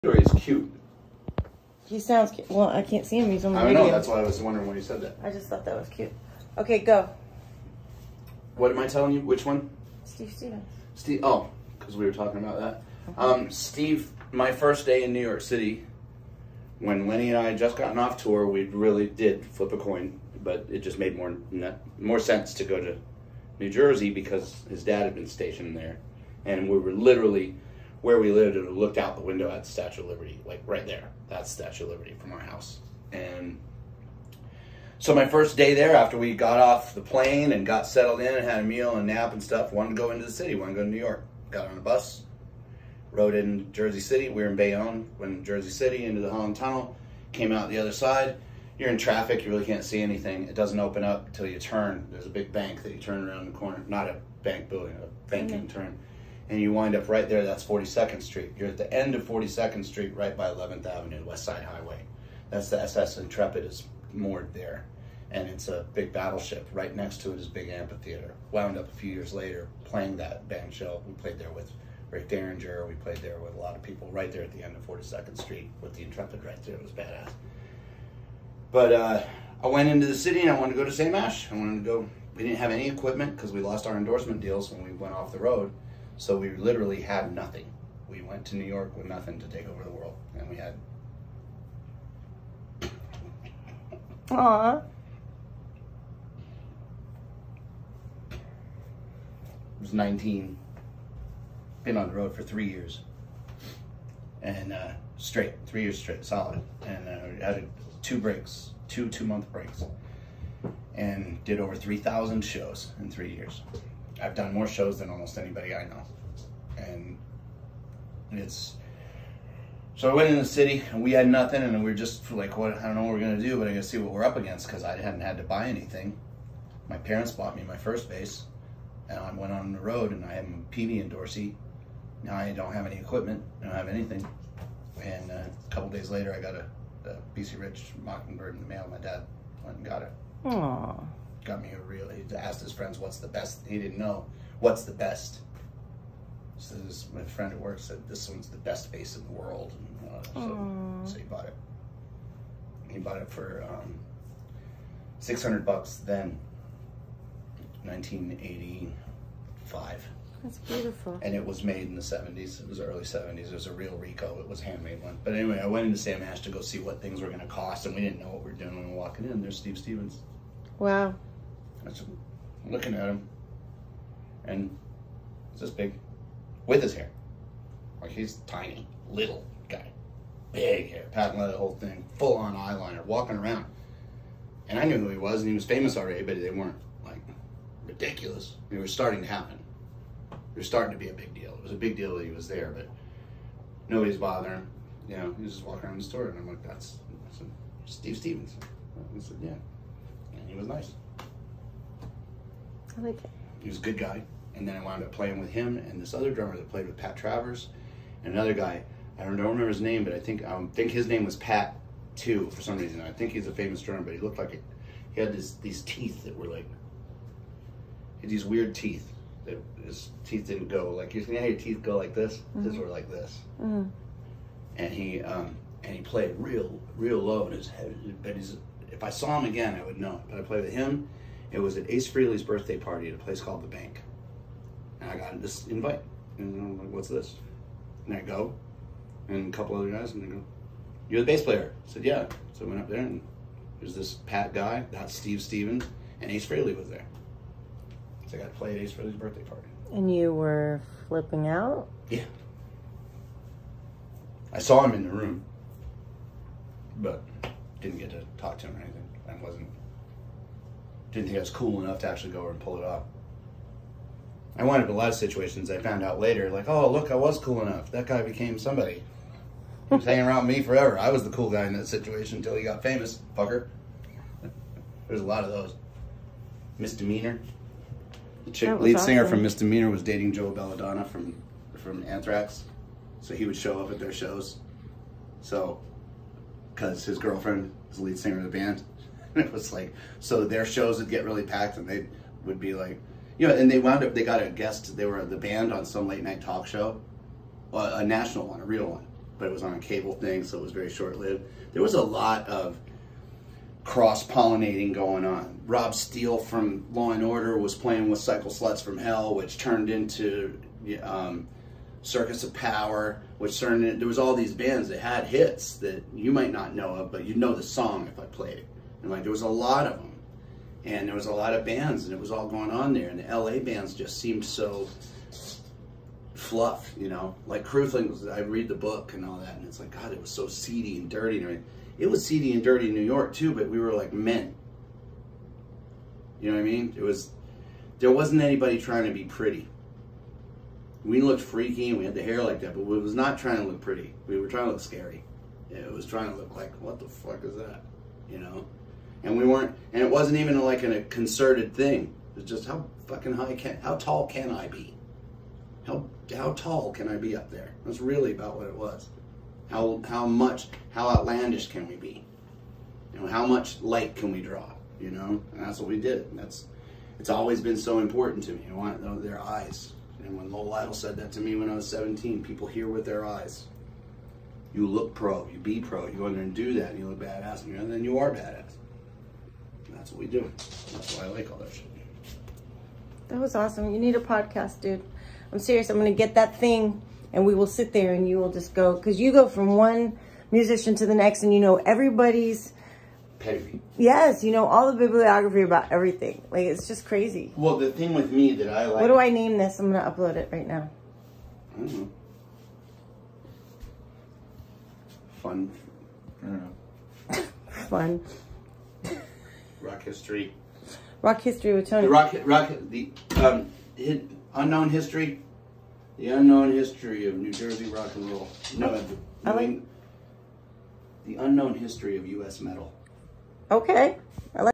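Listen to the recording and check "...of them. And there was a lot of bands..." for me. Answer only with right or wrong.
right.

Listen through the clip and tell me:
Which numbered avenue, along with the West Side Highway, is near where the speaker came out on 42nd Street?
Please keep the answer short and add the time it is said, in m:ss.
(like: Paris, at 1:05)
11th Avenue, at 1:00.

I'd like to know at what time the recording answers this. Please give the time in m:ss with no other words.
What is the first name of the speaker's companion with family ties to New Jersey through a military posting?
0:17.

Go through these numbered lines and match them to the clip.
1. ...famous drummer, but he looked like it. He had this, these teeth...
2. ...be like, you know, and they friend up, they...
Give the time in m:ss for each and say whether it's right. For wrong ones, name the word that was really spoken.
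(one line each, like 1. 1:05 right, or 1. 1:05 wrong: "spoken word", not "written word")
1. 3:33 right
2. 4:52 wrong: "wound", not "friend".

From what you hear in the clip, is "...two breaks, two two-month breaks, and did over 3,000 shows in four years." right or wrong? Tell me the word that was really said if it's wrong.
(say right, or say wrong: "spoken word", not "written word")
wrong: "three", not "four".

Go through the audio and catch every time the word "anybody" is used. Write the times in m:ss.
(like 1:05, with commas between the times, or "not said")
1:55, 5:38.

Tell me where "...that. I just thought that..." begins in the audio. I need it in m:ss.
0:05.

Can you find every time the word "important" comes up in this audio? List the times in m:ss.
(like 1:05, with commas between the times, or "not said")
6:07.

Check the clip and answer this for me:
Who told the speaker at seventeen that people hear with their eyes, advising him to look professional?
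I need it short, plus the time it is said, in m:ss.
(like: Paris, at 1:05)
Lowell Lytle, at 6:10.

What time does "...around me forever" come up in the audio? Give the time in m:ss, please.
4:30.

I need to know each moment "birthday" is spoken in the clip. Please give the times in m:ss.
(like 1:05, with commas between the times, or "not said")
3:52, 4:09.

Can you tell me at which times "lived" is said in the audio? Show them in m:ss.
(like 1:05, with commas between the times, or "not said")
0:28, 5:01.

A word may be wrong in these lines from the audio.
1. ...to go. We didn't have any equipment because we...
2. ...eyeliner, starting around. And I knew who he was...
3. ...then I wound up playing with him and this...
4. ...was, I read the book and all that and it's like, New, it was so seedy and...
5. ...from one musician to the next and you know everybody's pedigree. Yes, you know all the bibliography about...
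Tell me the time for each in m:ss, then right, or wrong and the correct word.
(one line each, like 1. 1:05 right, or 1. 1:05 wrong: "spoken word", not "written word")
1. 1:21 right
2. 3:02 wrong: "walking", not "starting"
3. 3:24 right
4. 5:28 wrong: "God", not "New"
5. 6:29 right.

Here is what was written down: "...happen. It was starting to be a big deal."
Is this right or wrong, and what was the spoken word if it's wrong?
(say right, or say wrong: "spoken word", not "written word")
right.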